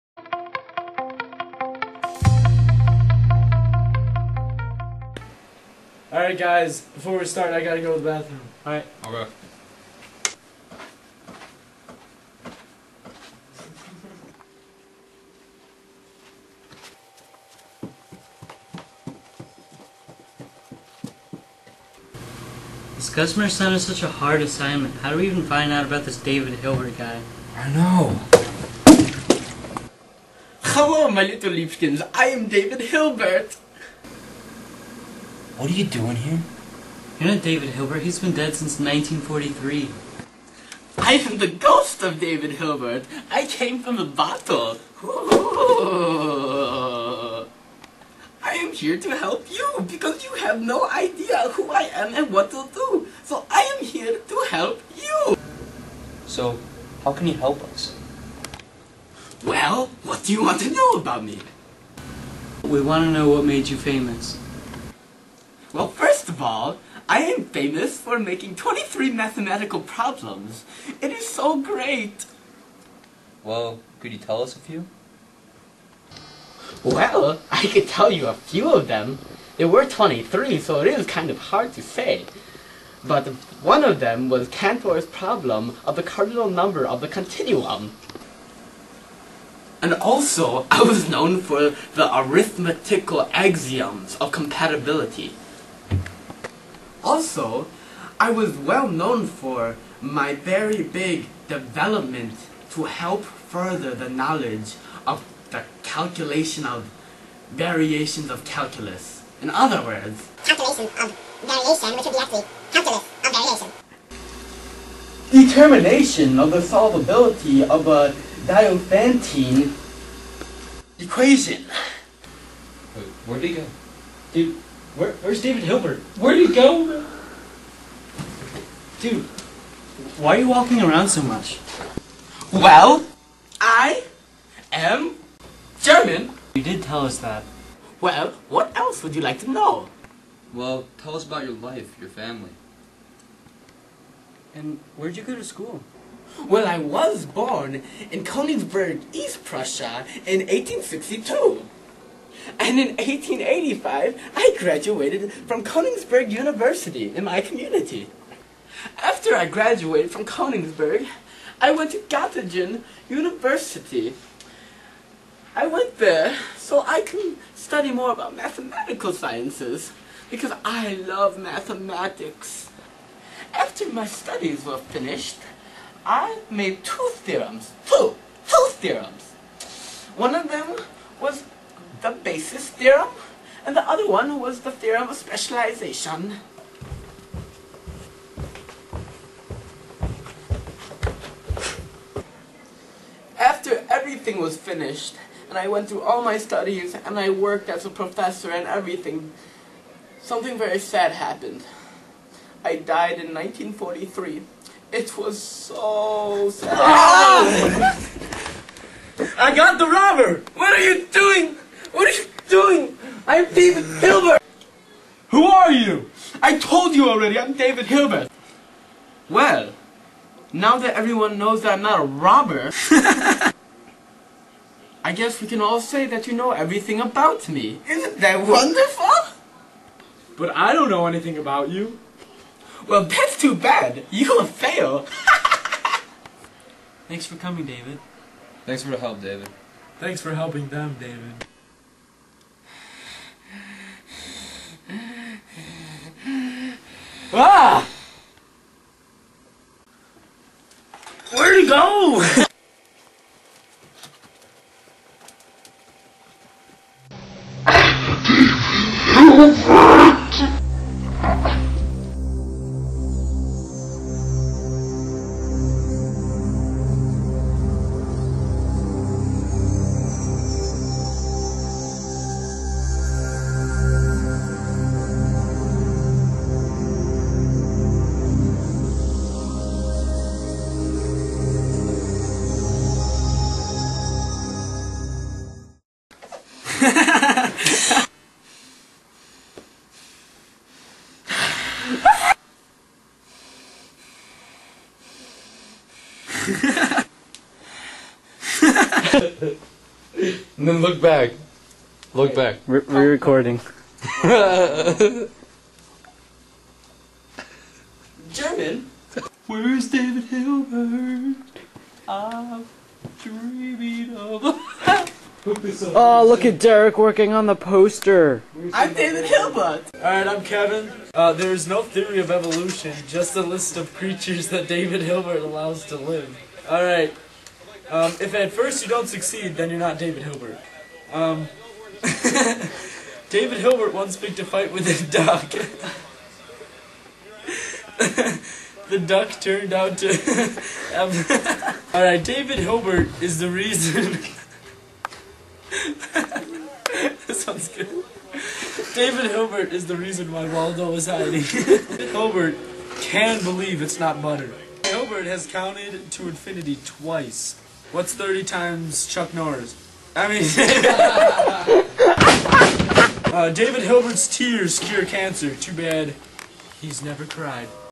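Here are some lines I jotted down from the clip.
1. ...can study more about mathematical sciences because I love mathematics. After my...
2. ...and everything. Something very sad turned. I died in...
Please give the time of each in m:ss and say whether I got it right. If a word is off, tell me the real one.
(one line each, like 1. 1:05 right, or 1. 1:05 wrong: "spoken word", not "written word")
1. 2:47 right
2. 3:18 wrong: "happened", not "turned".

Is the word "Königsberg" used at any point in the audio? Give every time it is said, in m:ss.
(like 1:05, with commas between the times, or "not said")
2:28, 2:35, 2:40.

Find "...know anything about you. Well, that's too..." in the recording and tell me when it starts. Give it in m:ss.
3:50.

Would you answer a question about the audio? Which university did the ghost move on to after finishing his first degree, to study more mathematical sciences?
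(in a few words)
Göttingen University.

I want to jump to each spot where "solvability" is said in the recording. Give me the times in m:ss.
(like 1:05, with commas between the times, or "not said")
1:56.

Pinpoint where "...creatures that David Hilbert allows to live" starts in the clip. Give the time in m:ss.
5:23.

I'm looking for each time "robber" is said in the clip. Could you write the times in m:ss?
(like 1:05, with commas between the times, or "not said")
3:29, 3:42.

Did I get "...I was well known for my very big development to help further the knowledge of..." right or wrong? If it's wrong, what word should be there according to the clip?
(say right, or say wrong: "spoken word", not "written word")
right.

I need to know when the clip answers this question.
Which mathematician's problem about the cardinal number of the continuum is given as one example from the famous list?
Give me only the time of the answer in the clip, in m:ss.
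1:24.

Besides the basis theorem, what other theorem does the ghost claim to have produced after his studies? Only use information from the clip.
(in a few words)
theorem of specialization.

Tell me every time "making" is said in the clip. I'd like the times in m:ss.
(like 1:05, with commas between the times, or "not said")
1:08.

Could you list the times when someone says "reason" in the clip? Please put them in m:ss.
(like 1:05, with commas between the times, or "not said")
5:43, 5:49.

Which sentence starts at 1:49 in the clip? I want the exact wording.
In other words, calculation of variation, which would be actually calculus of variation.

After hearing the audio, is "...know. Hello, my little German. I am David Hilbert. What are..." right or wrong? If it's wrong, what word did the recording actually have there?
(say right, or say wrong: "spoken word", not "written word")
wrong: "Leafkins", not "German".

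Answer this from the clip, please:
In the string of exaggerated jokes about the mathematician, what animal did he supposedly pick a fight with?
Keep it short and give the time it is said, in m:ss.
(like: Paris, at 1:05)
a duck, at 5:34.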